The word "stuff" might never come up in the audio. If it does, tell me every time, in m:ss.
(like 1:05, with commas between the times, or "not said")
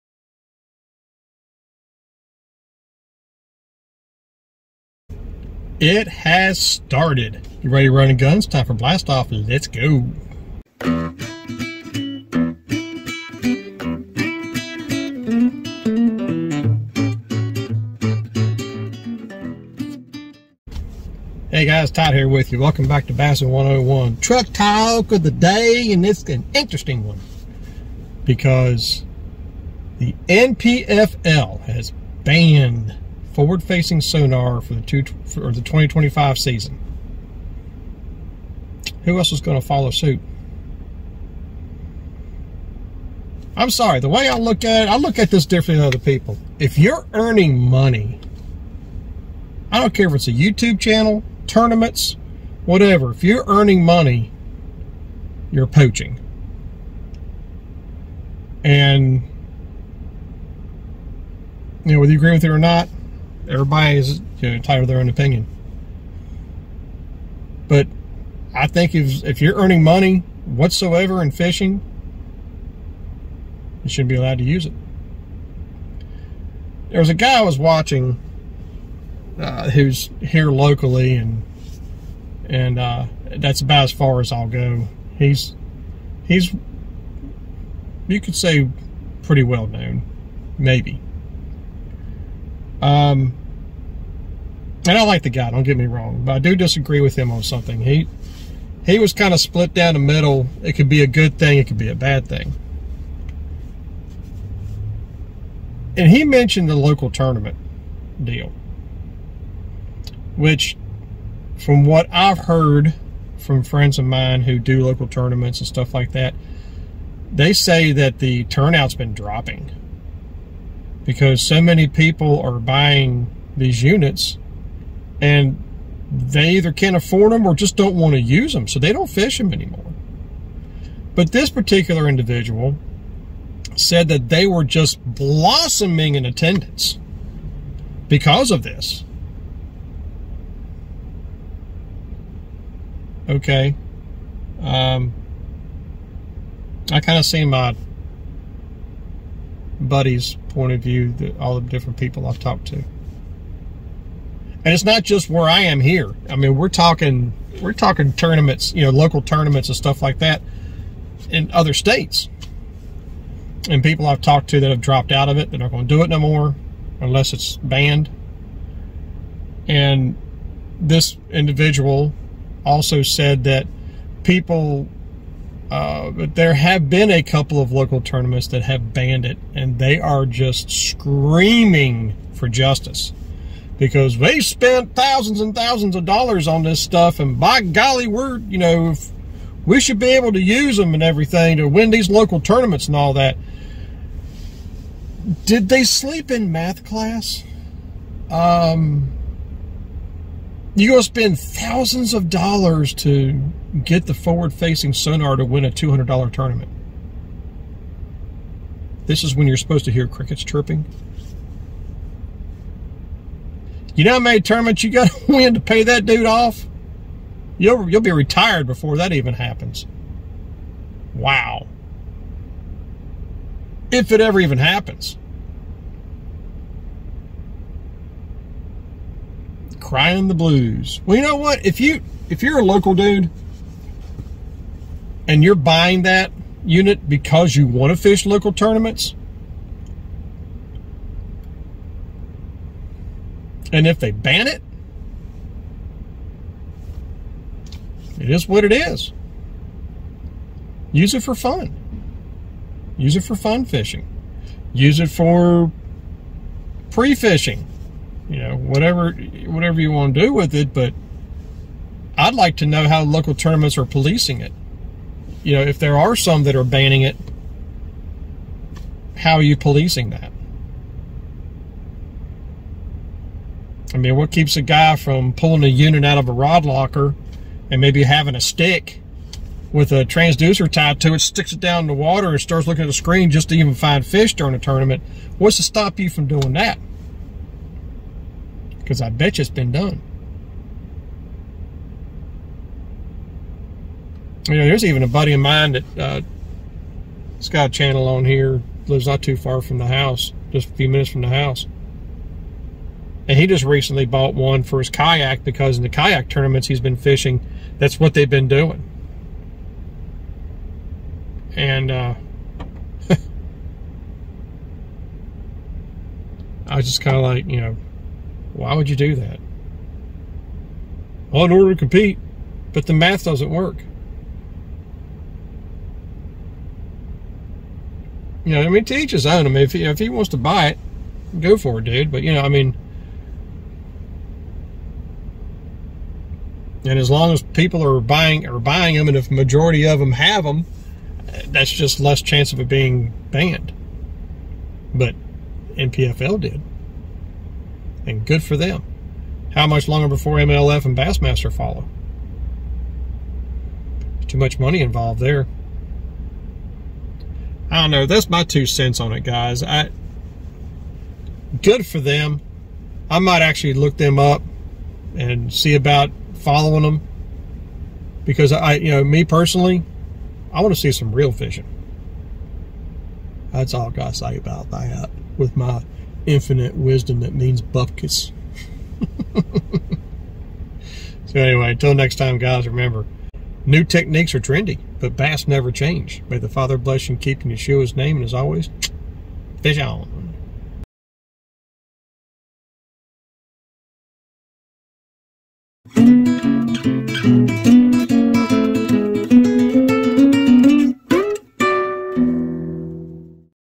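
1:55, 2:39, 3:06.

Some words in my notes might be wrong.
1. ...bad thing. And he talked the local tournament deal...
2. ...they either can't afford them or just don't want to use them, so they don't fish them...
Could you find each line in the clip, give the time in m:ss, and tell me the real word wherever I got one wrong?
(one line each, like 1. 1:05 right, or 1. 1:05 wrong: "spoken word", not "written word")
1. 1:41 wrong: "mentioned", not "talked"
2. 2:06 right.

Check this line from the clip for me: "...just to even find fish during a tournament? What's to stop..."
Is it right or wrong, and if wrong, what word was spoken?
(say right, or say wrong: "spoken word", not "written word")
right.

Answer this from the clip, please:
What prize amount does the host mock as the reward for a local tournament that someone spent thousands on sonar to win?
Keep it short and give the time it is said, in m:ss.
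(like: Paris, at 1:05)
$200, at 3:25.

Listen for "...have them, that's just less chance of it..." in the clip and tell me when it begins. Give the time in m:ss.
5:40.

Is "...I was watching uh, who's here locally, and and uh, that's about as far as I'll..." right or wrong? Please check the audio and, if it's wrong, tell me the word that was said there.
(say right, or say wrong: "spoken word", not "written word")
right.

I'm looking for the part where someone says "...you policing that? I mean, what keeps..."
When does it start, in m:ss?
4:29.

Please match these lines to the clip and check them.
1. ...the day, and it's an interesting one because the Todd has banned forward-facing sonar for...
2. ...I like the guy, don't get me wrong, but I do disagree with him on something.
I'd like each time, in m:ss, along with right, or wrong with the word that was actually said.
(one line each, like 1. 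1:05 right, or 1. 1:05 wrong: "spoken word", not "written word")
1. 0:25 wrong: "NPFL", not "Todd"
2. 1:34 right.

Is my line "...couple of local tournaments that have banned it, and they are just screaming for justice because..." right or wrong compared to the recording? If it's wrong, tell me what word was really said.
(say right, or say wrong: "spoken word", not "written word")
right.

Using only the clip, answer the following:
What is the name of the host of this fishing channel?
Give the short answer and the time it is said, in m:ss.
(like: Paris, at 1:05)
Todd, at 0:21.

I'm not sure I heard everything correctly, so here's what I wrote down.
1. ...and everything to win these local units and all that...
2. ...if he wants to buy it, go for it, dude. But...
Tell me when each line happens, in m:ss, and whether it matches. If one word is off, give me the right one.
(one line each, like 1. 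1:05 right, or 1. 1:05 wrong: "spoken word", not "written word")
1. 3:10 wrong: "tournaments", not "units"
2. 5:29 right.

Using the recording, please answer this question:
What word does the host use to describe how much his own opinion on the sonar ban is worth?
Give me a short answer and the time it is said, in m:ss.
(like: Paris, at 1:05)
bupkis, at 6:17.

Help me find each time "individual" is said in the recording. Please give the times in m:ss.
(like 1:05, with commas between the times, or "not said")
2:12, 2:51.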